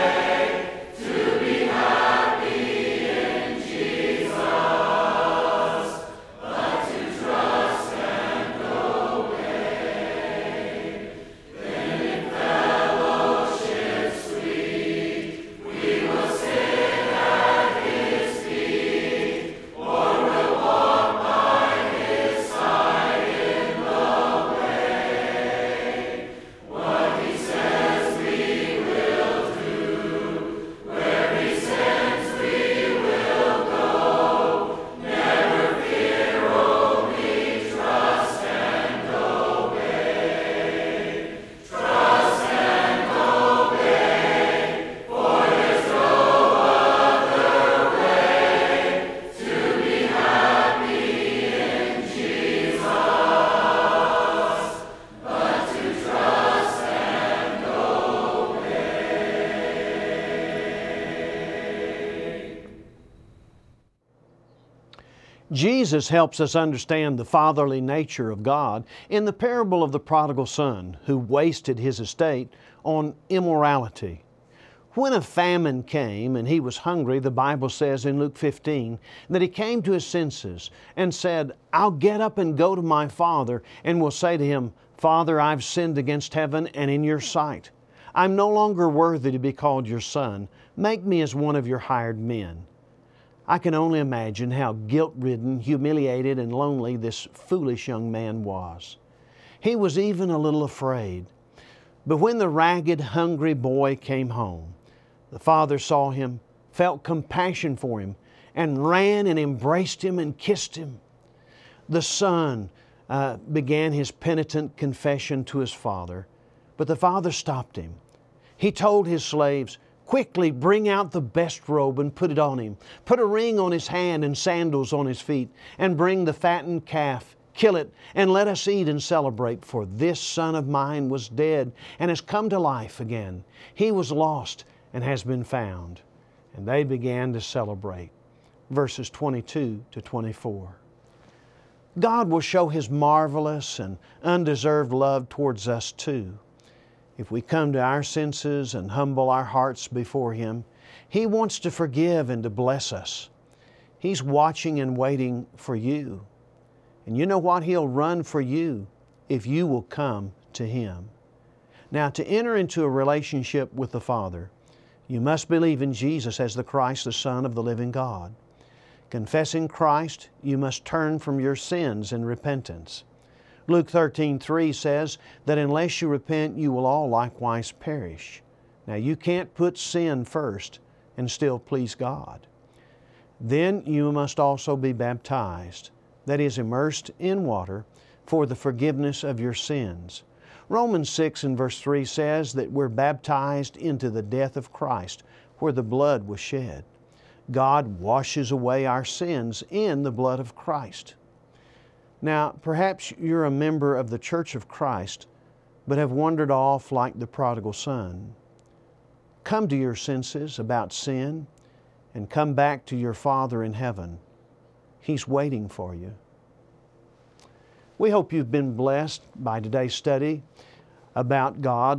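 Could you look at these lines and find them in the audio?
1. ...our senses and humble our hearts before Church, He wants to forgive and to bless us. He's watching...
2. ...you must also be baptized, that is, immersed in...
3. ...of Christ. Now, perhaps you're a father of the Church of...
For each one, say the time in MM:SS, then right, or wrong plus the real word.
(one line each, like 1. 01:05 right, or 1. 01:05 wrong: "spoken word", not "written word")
1. 02:27 wrong: "Him", not "Church"
2. 03:03 right
3. 03:20 wrong: "member", not "father".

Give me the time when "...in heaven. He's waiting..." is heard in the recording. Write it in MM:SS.
03:33.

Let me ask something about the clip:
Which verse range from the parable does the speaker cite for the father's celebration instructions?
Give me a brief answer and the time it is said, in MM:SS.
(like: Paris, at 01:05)
22 to 24, at 02:18.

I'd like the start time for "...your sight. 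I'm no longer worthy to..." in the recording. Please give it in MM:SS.
01:27.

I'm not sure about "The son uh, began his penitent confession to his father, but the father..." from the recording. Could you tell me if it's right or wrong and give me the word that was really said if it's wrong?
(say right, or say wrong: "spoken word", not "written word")
right.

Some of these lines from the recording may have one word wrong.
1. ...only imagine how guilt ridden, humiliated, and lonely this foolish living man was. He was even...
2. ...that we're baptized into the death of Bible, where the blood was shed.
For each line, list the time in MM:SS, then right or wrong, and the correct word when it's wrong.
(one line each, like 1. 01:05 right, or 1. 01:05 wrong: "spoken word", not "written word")
1. 01:33 wrong: "young", not "living"
2. 03:12 wrong: "Christ", not "Bible".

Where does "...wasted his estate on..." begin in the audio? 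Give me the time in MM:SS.
01:11.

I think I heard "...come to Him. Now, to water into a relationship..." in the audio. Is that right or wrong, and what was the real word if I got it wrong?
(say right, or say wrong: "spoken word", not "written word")
wrong: "enter", not "water".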